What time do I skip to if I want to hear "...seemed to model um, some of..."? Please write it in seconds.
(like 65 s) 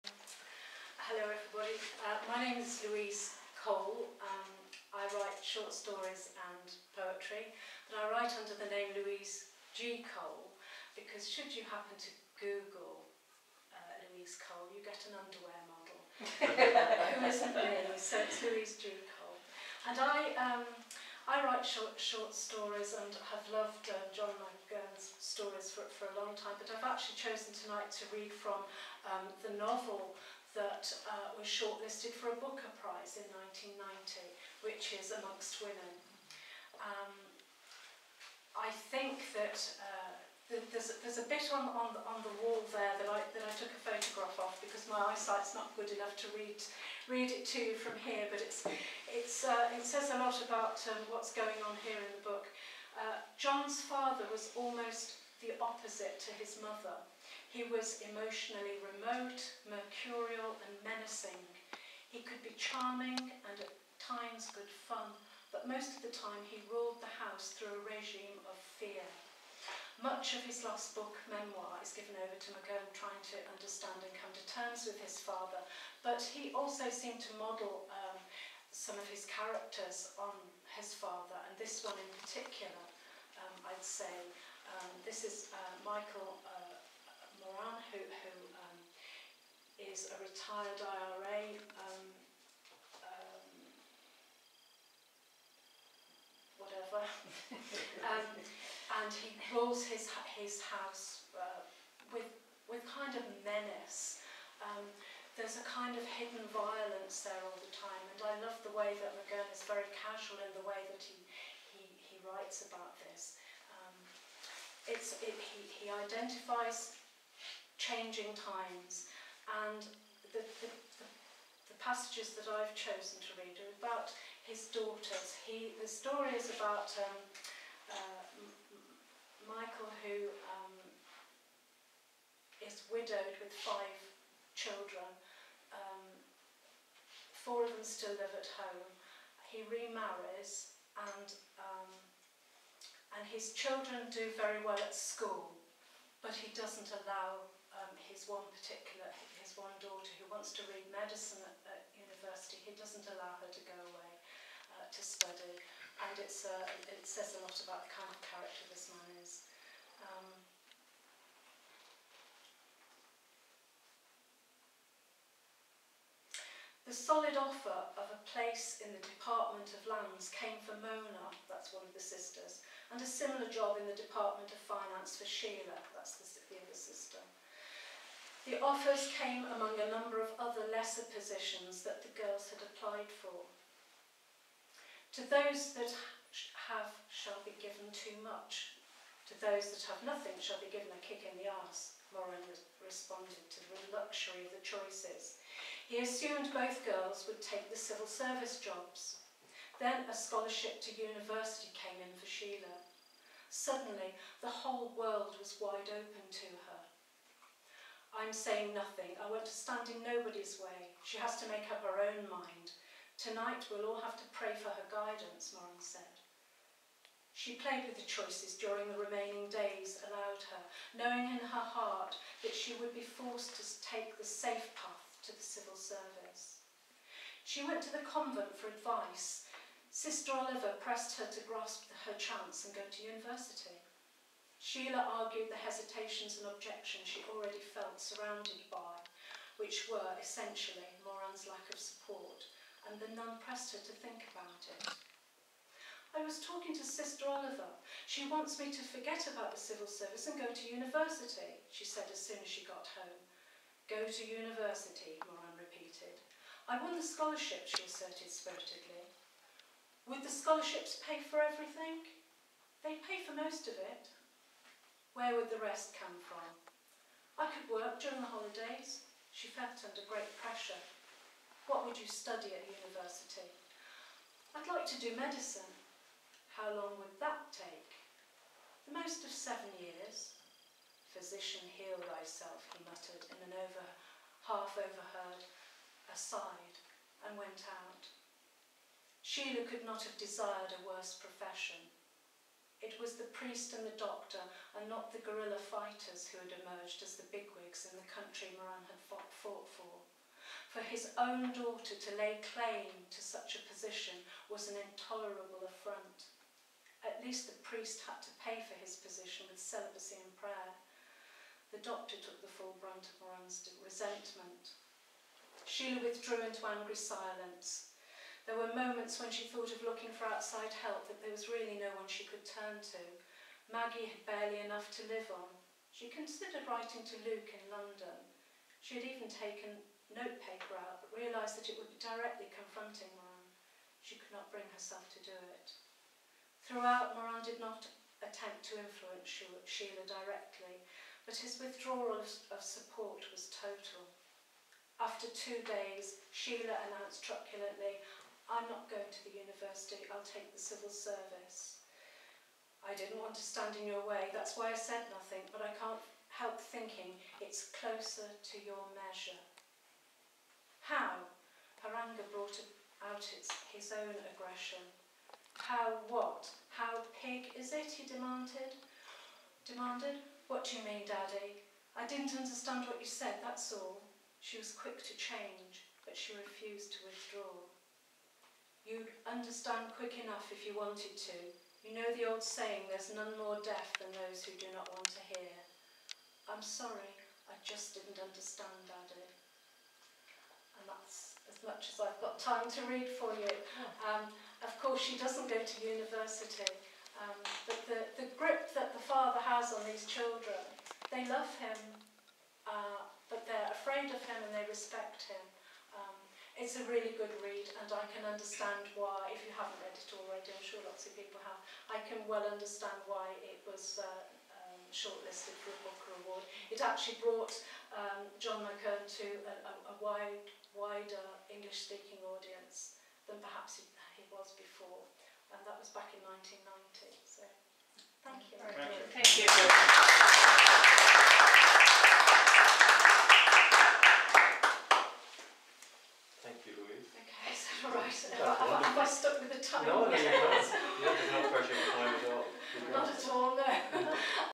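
76 s.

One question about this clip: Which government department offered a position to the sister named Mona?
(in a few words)
Department of Lands.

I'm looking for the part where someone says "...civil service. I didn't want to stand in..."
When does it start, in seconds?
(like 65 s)
350 s.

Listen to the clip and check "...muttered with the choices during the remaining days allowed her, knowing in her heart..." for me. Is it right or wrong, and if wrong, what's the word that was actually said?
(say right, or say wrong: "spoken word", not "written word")
wrong: "played", not "muttered".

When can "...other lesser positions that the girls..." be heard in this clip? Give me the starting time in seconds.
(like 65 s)
180 s.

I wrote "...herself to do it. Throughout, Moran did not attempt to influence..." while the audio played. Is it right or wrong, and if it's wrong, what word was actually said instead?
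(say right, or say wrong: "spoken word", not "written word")
right.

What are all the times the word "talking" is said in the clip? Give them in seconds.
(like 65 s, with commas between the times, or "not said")
246 s.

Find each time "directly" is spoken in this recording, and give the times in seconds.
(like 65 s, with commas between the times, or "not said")
332 s, 340 s.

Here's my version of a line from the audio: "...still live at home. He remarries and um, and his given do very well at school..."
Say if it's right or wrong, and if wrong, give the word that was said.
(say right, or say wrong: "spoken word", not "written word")
wrong: "children", not "given".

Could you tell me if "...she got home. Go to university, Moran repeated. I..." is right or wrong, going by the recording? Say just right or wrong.
right.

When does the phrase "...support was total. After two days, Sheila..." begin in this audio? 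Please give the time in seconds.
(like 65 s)
342 s.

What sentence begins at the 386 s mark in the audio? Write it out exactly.
I'm sorry, I just didn't understand, Daddy.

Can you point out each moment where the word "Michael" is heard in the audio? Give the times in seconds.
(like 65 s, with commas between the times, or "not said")
85 s, 129 s.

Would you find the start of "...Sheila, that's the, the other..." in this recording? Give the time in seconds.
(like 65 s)
175 s.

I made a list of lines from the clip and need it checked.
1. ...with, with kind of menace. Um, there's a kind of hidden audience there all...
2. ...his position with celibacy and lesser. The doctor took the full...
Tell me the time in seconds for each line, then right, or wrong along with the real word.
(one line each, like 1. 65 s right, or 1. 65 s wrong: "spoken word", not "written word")
1. 102 s wrong: "violence", not "audience"
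2. 308 s wrong: "prayer", not "lesser".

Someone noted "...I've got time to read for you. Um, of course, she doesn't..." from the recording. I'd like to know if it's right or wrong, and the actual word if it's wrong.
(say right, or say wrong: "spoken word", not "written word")
right.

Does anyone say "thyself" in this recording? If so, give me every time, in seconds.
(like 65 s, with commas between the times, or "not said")
282 s.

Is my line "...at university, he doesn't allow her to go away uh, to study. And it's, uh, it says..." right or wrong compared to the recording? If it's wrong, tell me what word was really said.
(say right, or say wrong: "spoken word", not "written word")
right.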